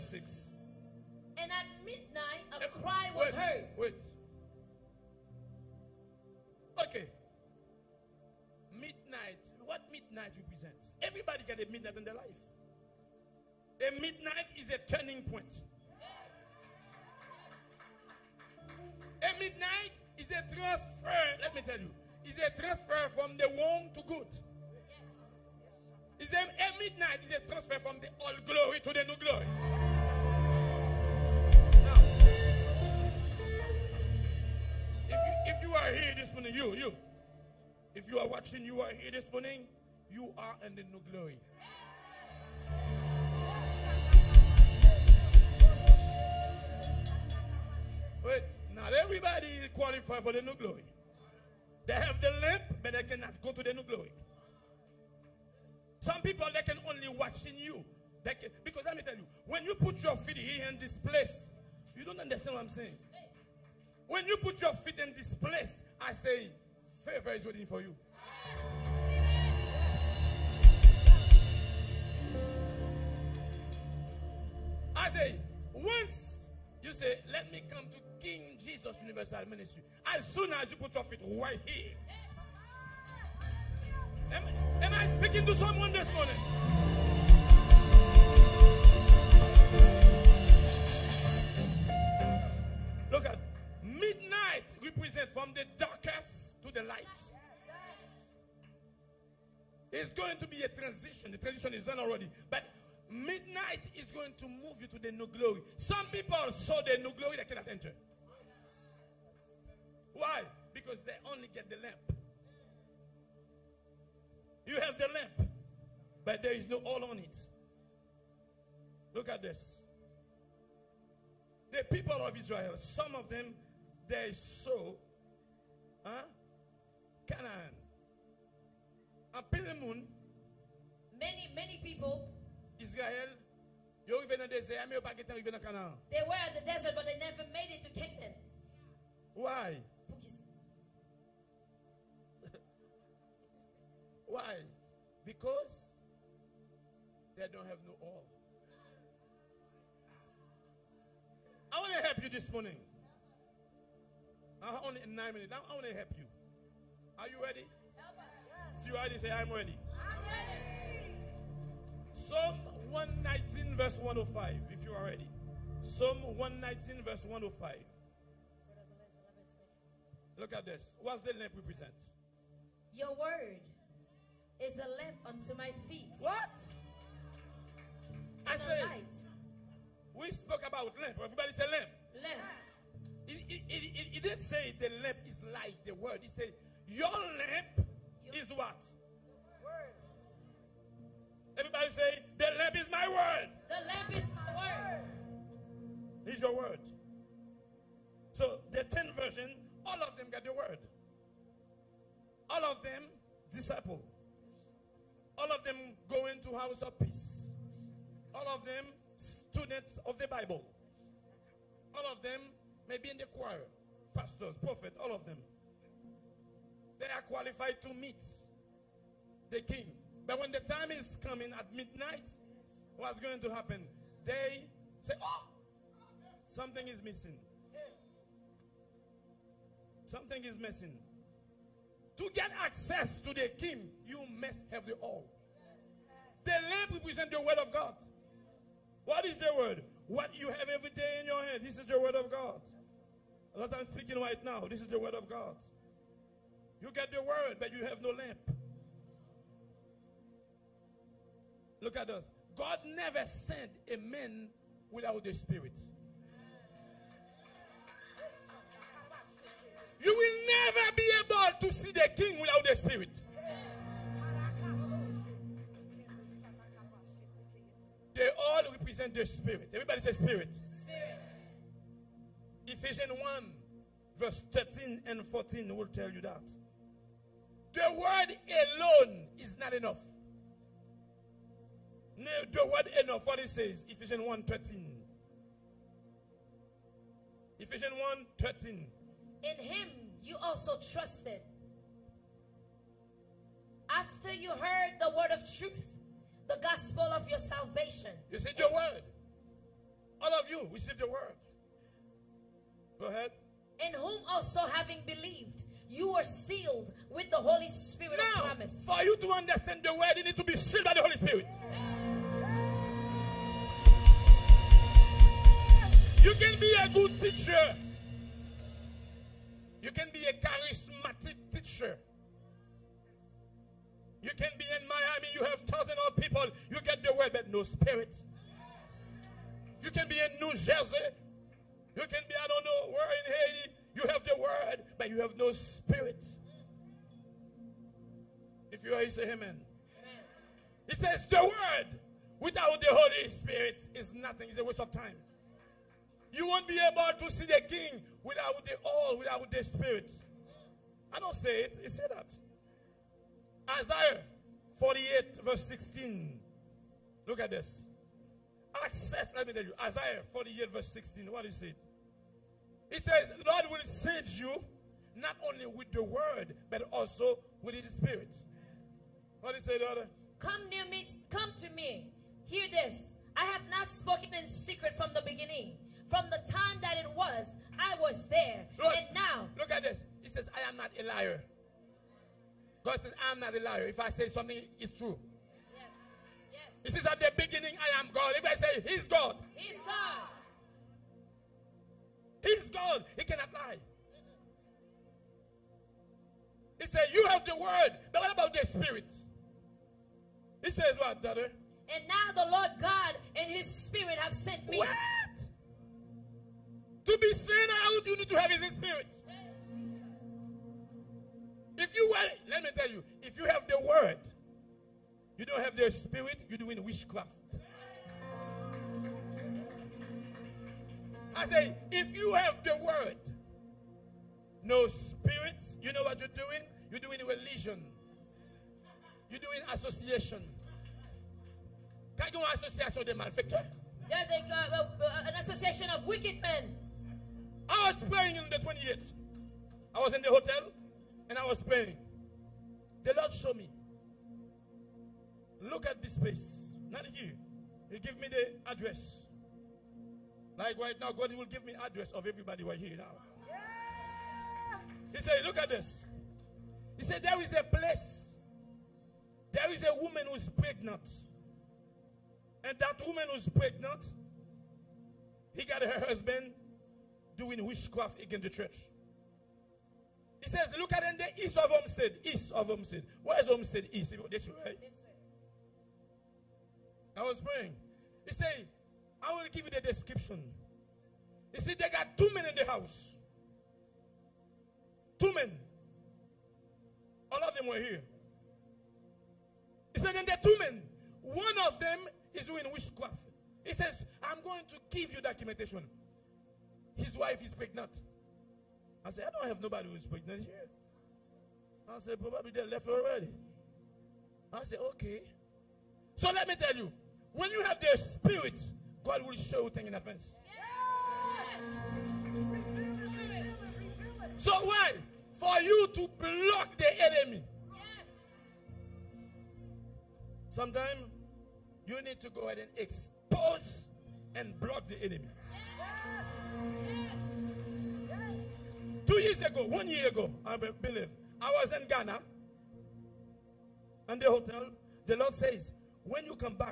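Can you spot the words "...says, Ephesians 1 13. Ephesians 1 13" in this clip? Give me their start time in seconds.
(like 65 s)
283 s.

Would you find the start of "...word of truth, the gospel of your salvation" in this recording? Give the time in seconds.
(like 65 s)
295 s.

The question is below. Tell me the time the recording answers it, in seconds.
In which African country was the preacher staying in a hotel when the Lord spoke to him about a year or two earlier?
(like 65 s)
531 s.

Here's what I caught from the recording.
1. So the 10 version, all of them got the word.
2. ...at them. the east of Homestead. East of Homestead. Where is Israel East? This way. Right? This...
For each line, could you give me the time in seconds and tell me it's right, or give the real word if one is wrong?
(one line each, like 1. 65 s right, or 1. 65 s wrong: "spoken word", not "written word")
1. 198 s right
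2. 470 s wrong: "Homestead", not "Israel".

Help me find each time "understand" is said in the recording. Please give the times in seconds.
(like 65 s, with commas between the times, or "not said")
62 s, 309 s.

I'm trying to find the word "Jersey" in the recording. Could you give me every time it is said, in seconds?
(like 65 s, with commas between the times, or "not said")
330 s.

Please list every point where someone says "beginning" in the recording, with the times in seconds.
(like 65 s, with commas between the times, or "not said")
375 s, 387 s.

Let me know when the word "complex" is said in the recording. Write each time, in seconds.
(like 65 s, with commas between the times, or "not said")
not said.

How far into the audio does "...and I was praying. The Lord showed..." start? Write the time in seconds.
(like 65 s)
441 s.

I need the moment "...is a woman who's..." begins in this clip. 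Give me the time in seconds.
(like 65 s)
459 s.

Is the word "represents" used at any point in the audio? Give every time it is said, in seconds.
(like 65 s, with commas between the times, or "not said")
10 s, 94 s, 171 s, 236 s, 268 s.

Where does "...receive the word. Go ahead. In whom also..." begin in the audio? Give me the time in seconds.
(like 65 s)
300 s.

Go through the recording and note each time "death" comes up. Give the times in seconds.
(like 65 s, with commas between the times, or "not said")
not said.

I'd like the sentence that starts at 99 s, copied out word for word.
It's going to be a transition.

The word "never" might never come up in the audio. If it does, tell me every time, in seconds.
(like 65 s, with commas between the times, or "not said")
137 s, 252 s, 260 s.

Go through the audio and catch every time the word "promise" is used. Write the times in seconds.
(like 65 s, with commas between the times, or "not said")
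308 s.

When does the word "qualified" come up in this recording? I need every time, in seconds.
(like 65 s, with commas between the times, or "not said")
49 s, 217 s.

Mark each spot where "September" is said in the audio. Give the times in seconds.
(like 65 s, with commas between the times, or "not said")
not said.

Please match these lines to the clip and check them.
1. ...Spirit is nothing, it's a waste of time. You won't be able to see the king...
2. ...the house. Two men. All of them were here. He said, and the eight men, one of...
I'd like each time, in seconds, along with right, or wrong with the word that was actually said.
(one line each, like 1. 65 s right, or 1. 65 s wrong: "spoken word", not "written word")
1. 343 s right
2. 482 s wrong: "two", not "eight".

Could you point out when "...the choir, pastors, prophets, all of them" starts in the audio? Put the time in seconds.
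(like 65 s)
213 s.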